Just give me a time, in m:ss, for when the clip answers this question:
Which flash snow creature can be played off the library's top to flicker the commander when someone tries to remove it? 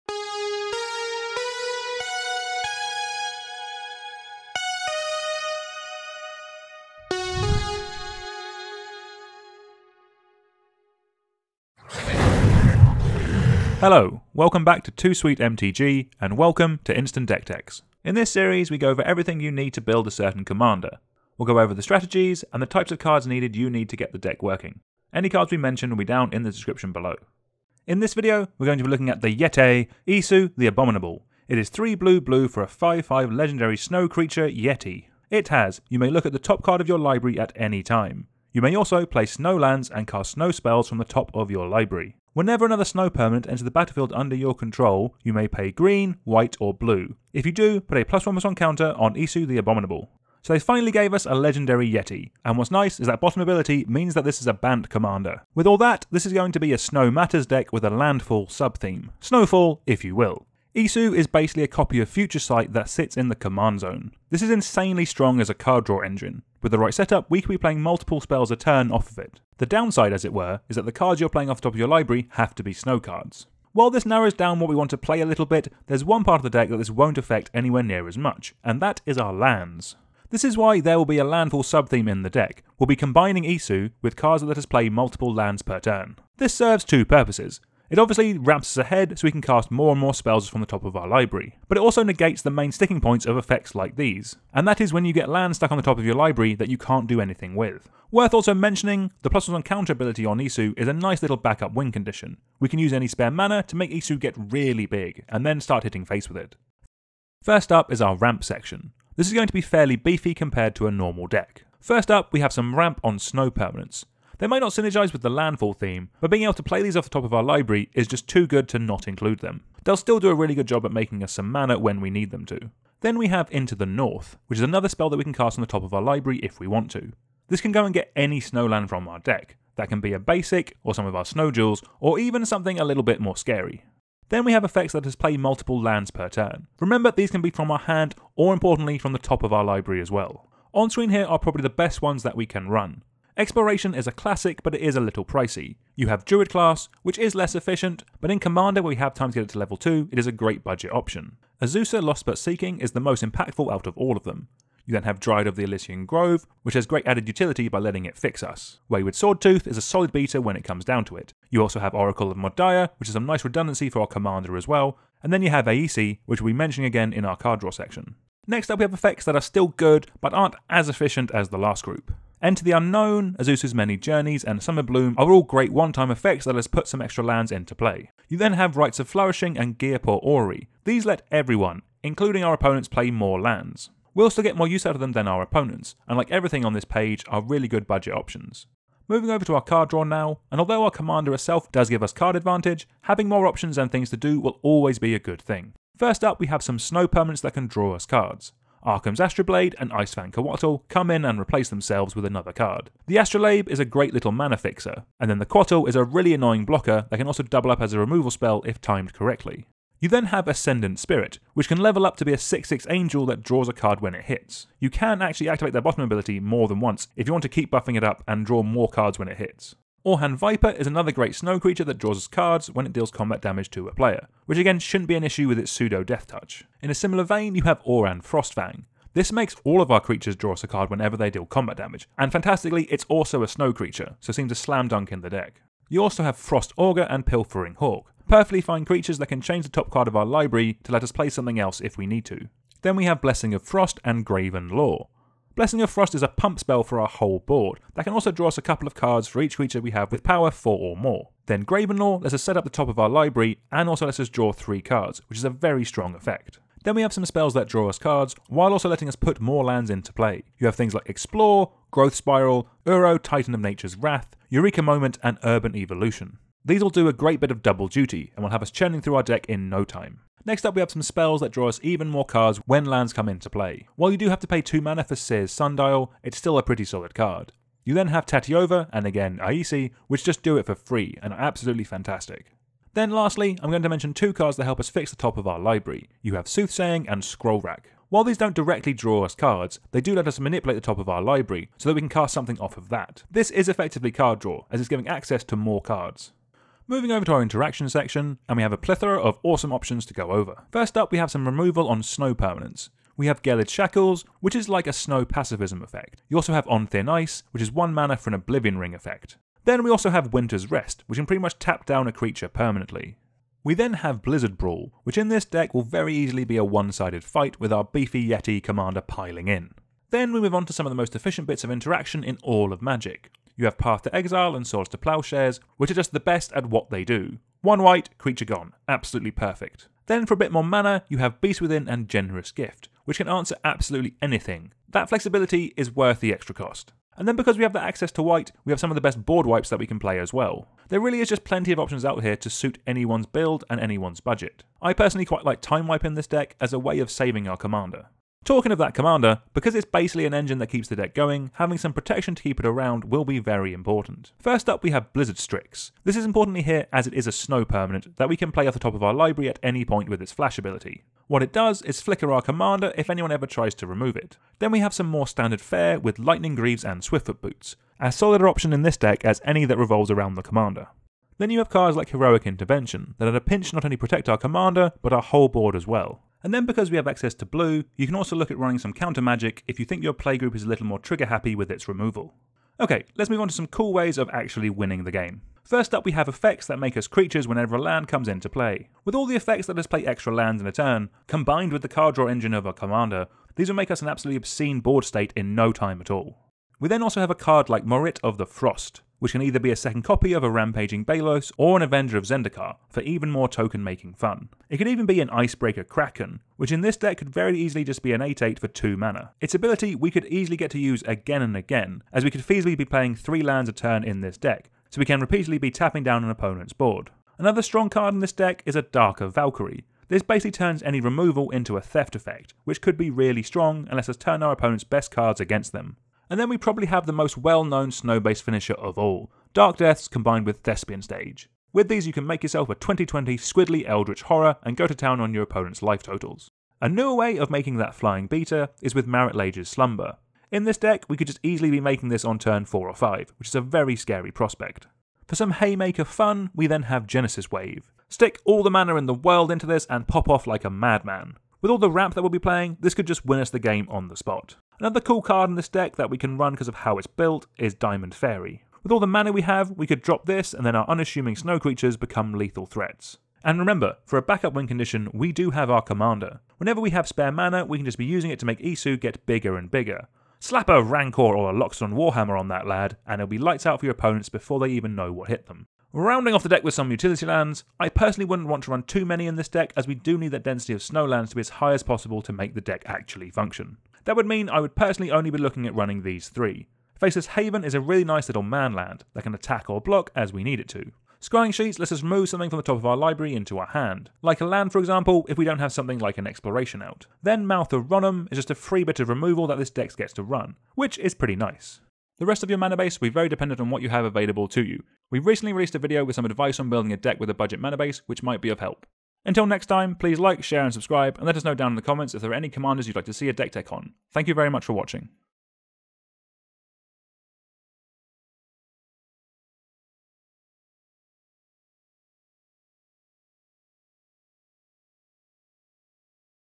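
5:55.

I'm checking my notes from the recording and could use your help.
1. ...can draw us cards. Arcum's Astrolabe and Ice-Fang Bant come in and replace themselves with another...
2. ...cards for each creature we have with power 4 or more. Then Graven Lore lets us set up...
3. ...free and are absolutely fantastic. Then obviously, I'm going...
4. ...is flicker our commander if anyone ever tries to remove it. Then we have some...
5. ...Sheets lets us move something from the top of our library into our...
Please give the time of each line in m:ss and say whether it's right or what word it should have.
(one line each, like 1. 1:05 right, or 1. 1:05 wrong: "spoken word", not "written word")
1. 3:17 wrong: "Coatl", not "Bant"
2. 4:08 right
3. 4:40 wrong: "lastly", not "obviously"
4. 6:01 right
5. 8:11 right.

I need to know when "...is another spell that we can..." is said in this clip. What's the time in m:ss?
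2:04.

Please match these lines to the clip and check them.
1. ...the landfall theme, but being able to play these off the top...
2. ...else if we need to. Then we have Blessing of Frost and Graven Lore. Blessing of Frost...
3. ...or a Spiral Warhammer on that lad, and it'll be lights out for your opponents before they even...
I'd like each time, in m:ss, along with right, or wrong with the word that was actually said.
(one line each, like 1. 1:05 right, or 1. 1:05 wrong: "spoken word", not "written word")
1. 1:55 right
2. 4:01 right
3. 7:51 wrong: "Loxodon", not "Spiral".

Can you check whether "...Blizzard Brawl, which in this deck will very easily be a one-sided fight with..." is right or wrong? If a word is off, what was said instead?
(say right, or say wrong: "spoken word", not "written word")
right.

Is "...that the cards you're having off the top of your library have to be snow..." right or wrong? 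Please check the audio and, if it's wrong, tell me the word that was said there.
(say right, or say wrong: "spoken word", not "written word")
wrong: "playing", not "having".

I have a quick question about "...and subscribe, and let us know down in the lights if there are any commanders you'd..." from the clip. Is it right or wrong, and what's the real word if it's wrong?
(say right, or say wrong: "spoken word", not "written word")
wrong: "comments", not "lights".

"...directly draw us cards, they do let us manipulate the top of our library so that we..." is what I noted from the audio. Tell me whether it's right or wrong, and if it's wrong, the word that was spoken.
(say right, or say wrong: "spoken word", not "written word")
right.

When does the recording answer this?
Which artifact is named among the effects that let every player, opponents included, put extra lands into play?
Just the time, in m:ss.
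2:59.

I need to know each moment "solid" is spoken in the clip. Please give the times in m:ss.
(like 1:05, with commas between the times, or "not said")
2:39, 4:36, 6:08.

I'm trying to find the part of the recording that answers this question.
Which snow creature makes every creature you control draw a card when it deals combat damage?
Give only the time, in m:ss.
3:47.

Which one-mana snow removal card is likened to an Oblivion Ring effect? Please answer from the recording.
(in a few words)
On Thin Ice.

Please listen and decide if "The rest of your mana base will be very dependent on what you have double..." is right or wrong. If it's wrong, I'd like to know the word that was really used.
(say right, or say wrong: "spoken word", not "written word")
wrong: "available", not "double".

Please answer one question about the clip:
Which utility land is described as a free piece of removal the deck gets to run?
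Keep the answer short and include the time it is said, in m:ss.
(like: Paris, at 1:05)
Mouth of Ronom, at 8:17.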